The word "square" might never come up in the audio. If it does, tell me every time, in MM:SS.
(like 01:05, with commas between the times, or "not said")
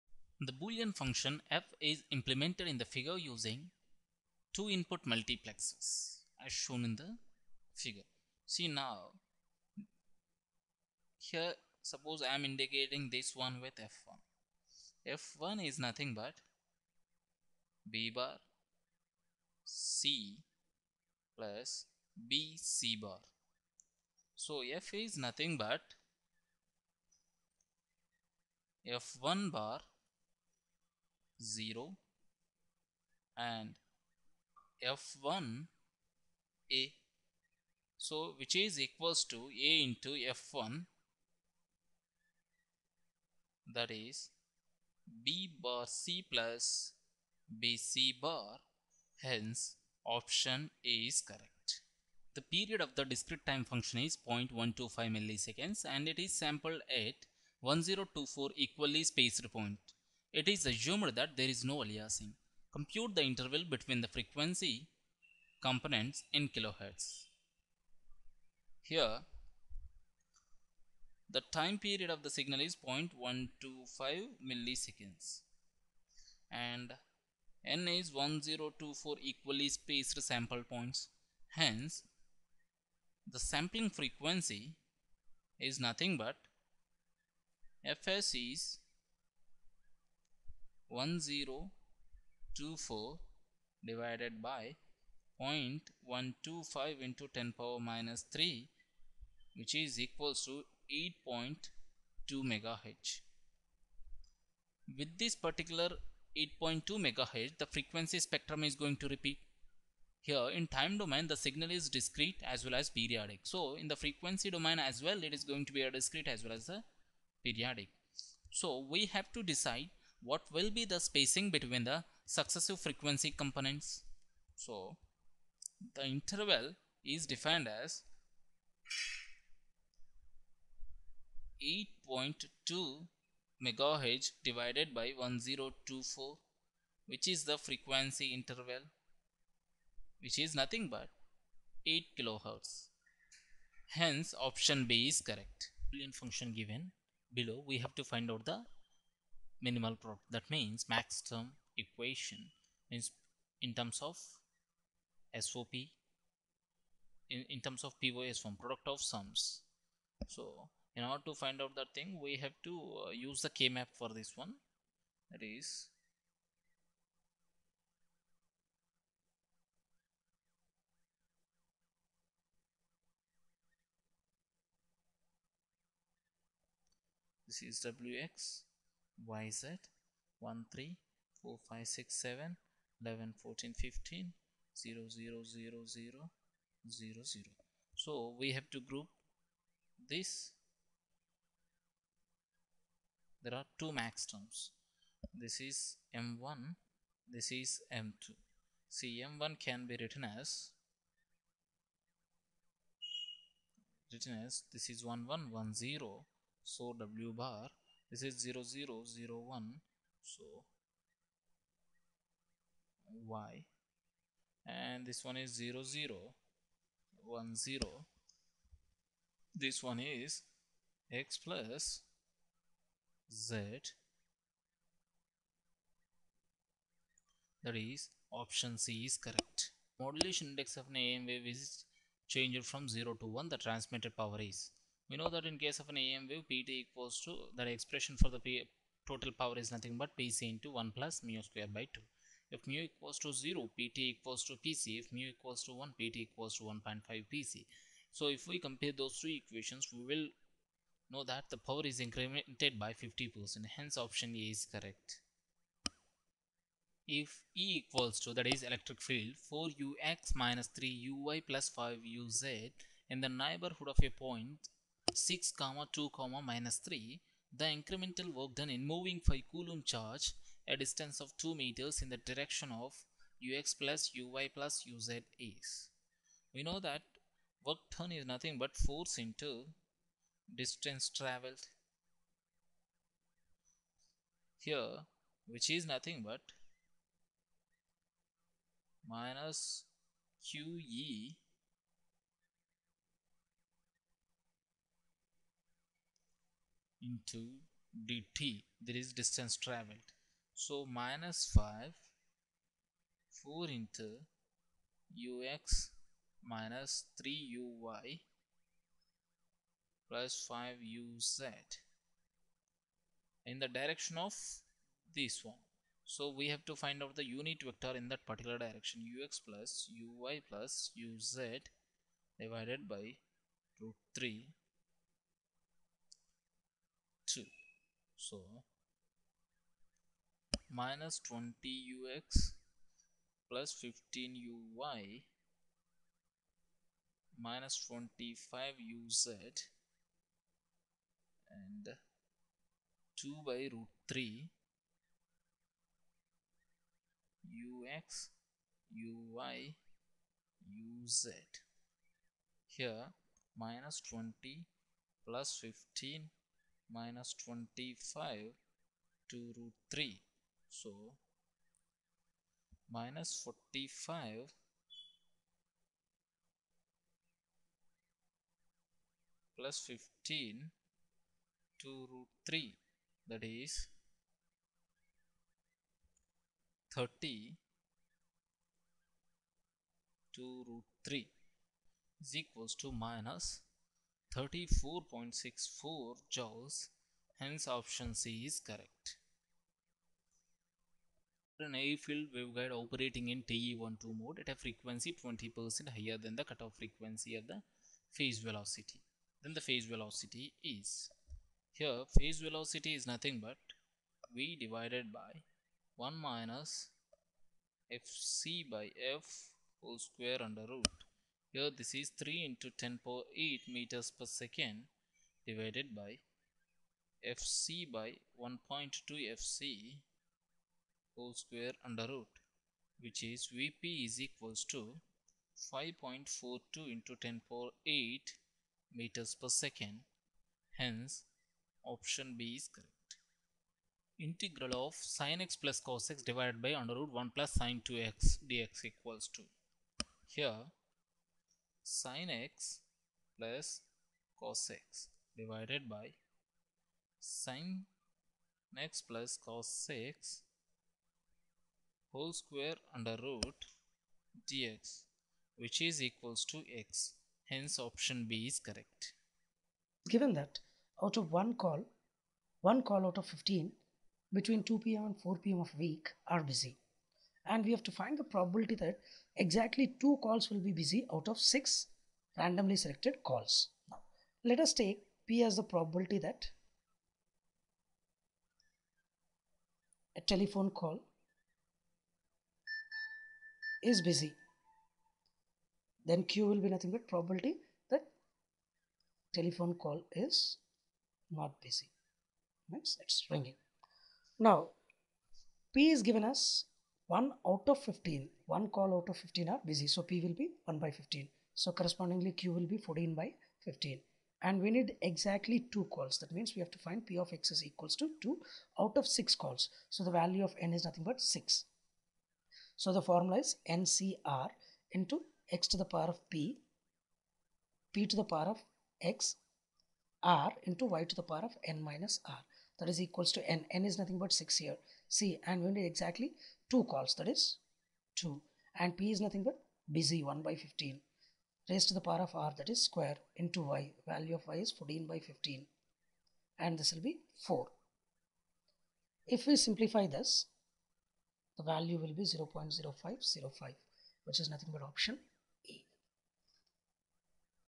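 04:01, 06:49, 07:01, 07:32, 08:52.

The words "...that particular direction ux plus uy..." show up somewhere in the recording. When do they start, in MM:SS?
05:18.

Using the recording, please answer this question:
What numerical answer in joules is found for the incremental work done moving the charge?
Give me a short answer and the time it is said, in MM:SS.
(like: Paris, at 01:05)
-34.64 joules, at 06:22.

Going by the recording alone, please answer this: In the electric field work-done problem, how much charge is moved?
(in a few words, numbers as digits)
5 coulomb.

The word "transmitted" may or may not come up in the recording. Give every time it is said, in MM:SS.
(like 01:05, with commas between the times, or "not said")
03:53.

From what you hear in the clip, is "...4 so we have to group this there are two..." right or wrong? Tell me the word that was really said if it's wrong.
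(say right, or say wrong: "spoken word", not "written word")
wrong: "0", not "4".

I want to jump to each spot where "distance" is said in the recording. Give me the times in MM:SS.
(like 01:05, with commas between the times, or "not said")
04:30, 04:40, 04:59.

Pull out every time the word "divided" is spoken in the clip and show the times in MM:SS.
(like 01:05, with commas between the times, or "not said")
01:33, 02:14, 05:22, 06:44, 06:55, 07:16, 07:25.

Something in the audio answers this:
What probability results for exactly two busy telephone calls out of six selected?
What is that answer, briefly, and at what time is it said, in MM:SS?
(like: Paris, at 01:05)
0.0505, at 09:02.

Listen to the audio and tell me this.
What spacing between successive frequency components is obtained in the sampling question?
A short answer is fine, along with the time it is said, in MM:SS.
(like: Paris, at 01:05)
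8 kilohertz, at 02:21.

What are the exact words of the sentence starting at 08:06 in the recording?
Then Q will be nothing but probability that telephone call is not busy.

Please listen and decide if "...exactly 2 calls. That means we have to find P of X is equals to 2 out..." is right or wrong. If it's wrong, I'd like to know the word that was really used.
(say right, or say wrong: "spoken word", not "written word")
right.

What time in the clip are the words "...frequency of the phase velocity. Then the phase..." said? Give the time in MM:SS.
06:36.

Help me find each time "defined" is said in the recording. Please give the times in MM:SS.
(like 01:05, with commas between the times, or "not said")
02:07.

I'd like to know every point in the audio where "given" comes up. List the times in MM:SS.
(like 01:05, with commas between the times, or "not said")
02:26, 07:40, 08:16.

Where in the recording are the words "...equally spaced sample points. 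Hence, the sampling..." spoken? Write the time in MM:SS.
01:19.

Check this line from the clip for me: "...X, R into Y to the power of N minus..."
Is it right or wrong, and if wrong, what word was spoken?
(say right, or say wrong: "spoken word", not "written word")
right.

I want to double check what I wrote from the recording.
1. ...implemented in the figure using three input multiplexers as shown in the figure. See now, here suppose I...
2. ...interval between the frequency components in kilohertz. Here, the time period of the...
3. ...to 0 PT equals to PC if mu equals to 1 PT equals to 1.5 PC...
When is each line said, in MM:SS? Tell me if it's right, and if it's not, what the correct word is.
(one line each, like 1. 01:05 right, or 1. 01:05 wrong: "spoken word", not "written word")
1. 00:02 wrong: "two", not "three"
2. 01:03 right
3. 04:03 right.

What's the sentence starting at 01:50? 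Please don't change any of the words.
Here in time domain, the signal is discrete as well as periodic.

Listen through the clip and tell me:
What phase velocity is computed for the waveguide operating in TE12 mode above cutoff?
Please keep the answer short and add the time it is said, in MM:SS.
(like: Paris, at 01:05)
5.42 × 10^8 m/s, at 07:05.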